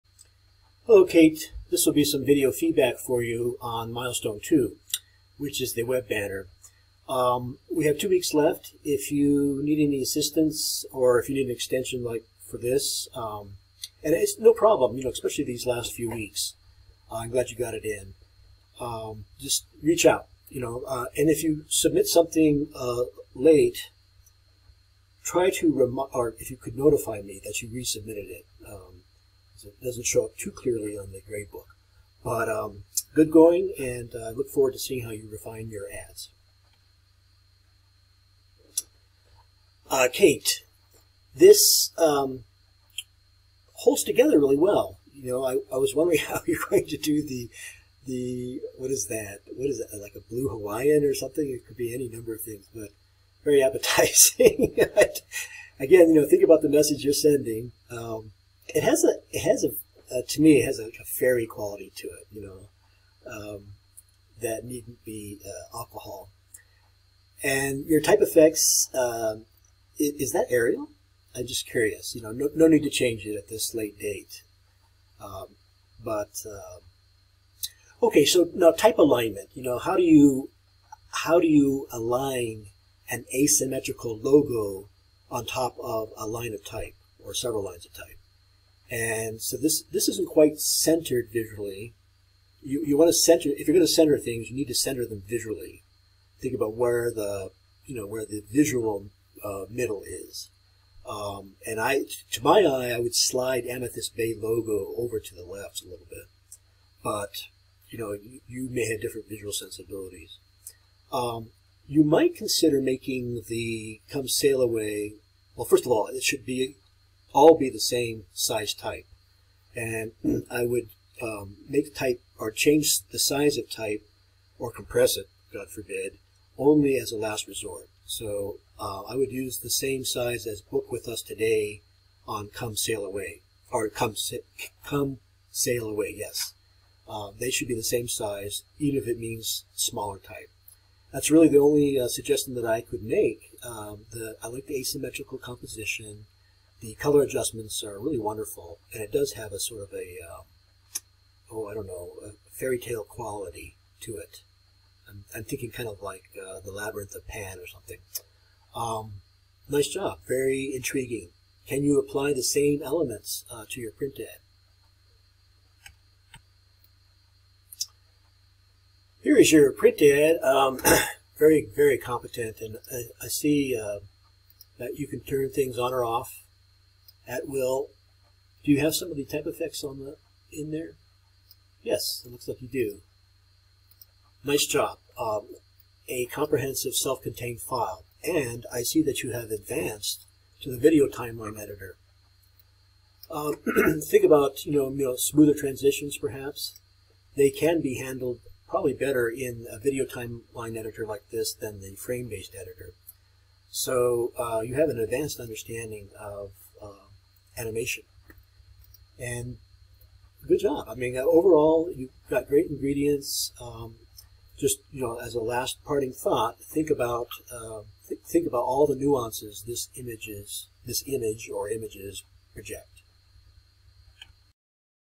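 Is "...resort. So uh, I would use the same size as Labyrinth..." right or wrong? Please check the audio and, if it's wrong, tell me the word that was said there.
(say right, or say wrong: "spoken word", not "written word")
wrong: "Book", not "Labyrinth".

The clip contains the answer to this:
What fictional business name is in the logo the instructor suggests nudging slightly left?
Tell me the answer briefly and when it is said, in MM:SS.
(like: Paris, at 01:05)
Amethyst Bay, at 01:43.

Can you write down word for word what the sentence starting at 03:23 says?
So uh, you have an advanced understanding of animation.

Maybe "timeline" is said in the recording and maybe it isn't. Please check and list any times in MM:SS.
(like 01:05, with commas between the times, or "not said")
03:11, 03:20.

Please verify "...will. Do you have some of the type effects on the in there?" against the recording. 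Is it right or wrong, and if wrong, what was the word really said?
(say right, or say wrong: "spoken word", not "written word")
right.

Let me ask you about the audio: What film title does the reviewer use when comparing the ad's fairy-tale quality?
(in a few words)
The Labyrinth of Pan.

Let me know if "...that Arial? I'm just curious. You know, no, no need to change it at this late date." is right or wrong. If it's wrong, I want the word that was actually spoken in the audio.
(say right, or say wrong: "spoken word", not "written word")
right.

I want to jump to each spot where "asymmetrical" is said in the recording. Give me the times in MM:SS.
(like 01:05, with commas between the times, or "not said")
01:23, 02:24.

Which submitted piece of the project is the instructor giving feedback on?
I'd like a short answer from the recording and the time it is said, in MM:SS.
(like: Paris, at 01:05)
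The web banner, at 00:05.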